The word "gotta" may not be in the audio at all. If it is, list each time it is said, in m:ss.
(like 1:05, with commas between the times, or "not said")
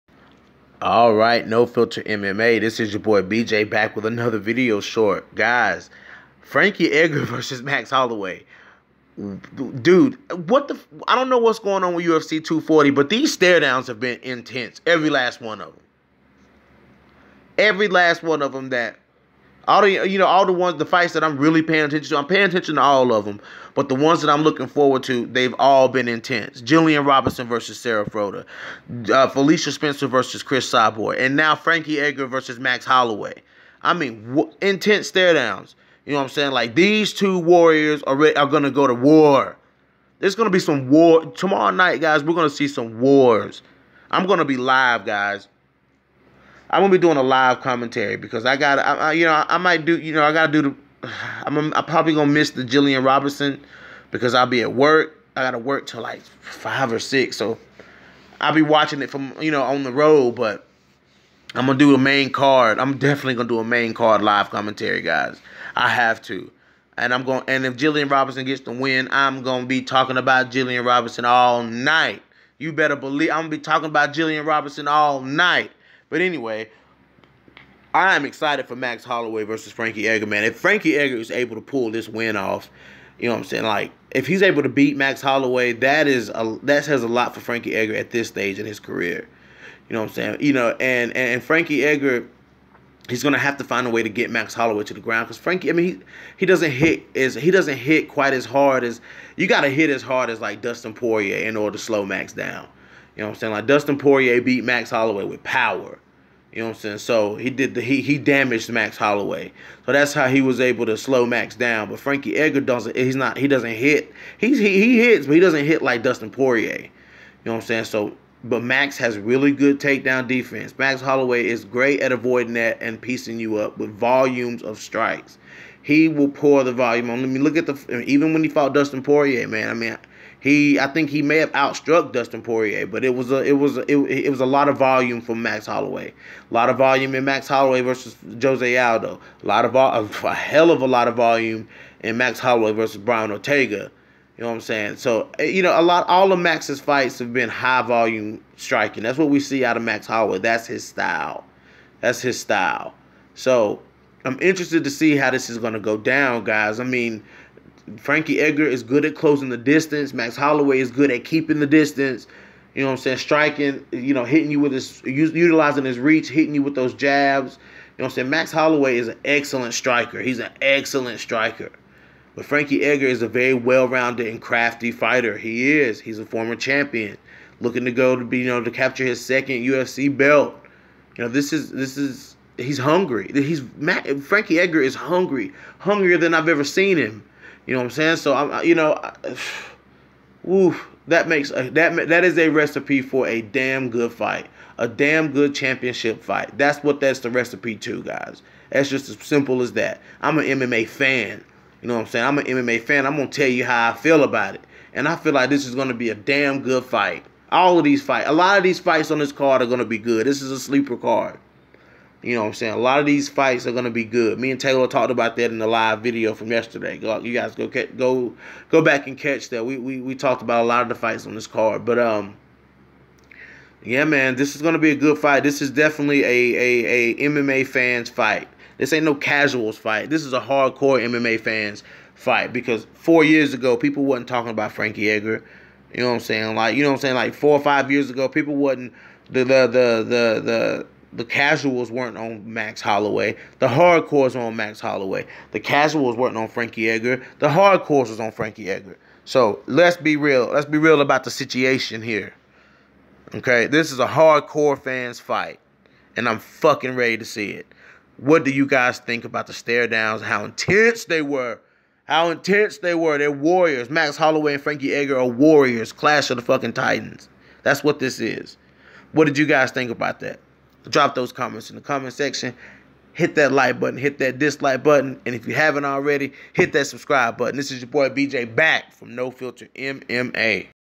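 0:50, 0:55, 1:39.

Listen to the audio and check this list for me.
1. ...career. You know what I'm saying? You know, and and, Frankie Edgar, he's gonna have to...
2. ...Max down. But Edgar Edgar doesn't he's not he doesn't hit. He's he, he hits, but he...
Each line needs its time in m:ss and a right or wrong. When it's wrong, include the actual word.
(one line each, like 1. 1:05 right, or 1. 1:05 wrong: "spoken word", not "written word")
1. 1:28 right
2. 1:51 wrong: "Frankie", not "Edgar".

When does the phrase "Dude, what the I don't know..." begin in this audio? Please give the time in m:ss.
0:09.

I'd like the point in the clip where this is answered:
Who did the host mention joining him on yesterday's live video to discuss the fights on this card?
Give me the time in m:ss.
3:34.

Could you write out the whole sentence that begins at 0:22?
I'm paying attention to all of them, but the ones that I'm looking forward to, they've all been intense.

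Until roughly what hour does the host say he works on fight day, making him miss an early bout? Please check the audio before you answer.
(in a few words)
five or six.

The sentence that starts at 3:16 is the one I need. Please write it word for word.
That's what that's the recipe to, guys.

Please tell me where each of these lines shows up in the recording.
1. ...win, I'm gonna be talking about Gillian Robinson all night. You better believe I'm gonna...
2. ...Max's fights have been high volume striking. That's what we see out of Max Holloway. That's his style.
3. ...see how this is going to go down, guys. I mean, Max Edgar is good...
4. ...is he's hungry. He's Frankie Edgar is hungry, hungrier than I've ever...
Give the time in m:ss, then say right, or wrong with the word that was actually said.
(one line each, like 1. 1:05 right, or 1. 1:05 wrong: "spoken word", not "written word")
1. 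1:08 right
2. 2:26 right
3. 2:34 wrong: "Frankie", not "Max"
4. 3:01 right.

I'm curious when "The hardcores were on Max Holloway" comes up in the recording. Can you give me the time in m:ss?
4:03.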